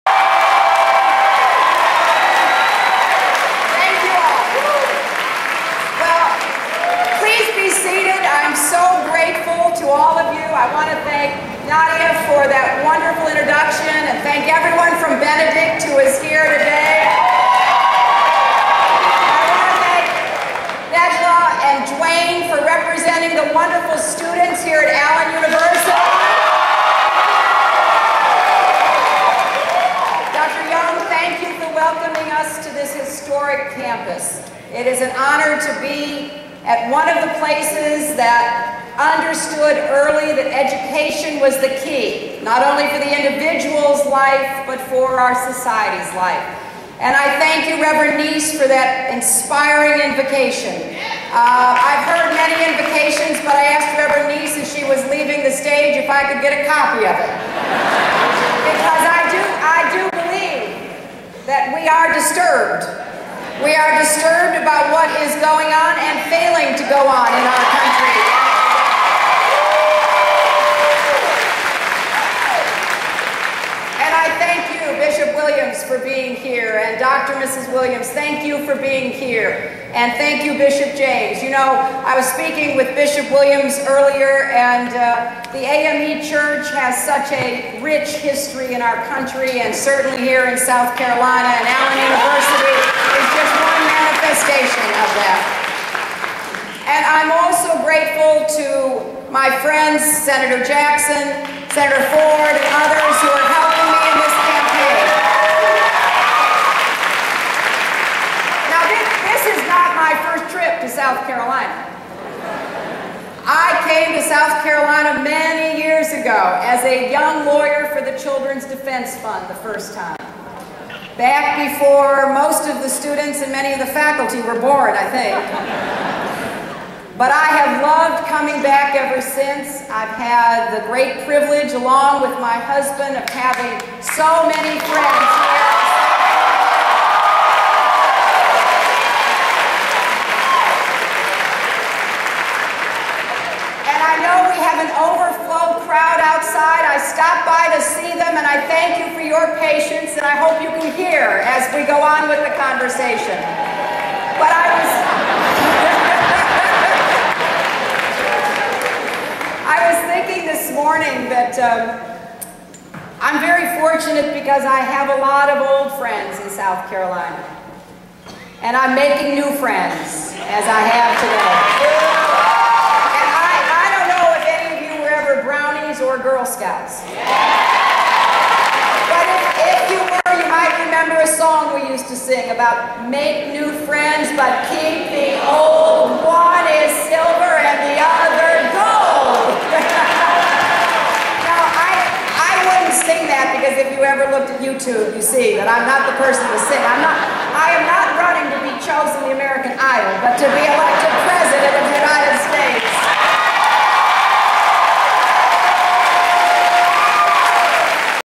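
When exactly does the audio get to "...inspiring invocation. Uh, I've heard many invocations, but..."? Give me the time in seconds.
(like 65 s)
49 s.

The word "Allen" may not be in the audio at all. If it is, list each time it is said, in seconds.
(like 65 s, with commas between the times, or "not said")
24 s, 91 s.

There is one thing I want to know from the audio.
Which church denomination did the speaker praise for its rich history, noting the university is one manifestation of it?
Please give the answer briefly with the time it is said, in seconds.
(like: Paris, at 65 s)
AME Church, at 85 s.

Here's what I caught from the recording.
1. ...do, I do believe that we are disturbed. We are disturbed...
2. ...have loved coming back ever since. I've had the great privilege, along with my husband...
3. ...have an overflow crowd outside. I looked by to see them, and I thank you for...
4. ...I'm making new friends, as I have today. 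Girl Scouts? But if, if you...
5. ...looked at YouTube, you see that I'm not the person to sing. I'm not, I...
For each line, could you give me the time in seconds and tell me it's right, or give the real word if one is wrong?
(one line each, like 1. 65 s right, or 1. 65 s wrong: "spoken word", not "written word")
1. 59 s right
2. 127 s right
3. 144 s wrong: "stopped", not "looked"
4. 168 s right
5. 194 s right.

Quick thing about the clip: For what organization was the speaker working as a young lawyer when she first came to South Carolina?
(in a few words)
Children's Defense Fund.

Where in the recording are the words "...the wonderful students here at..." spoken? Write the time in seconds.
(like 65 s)
23 s.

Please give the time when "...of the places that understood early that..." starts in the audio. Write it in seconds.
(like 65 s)
37 s.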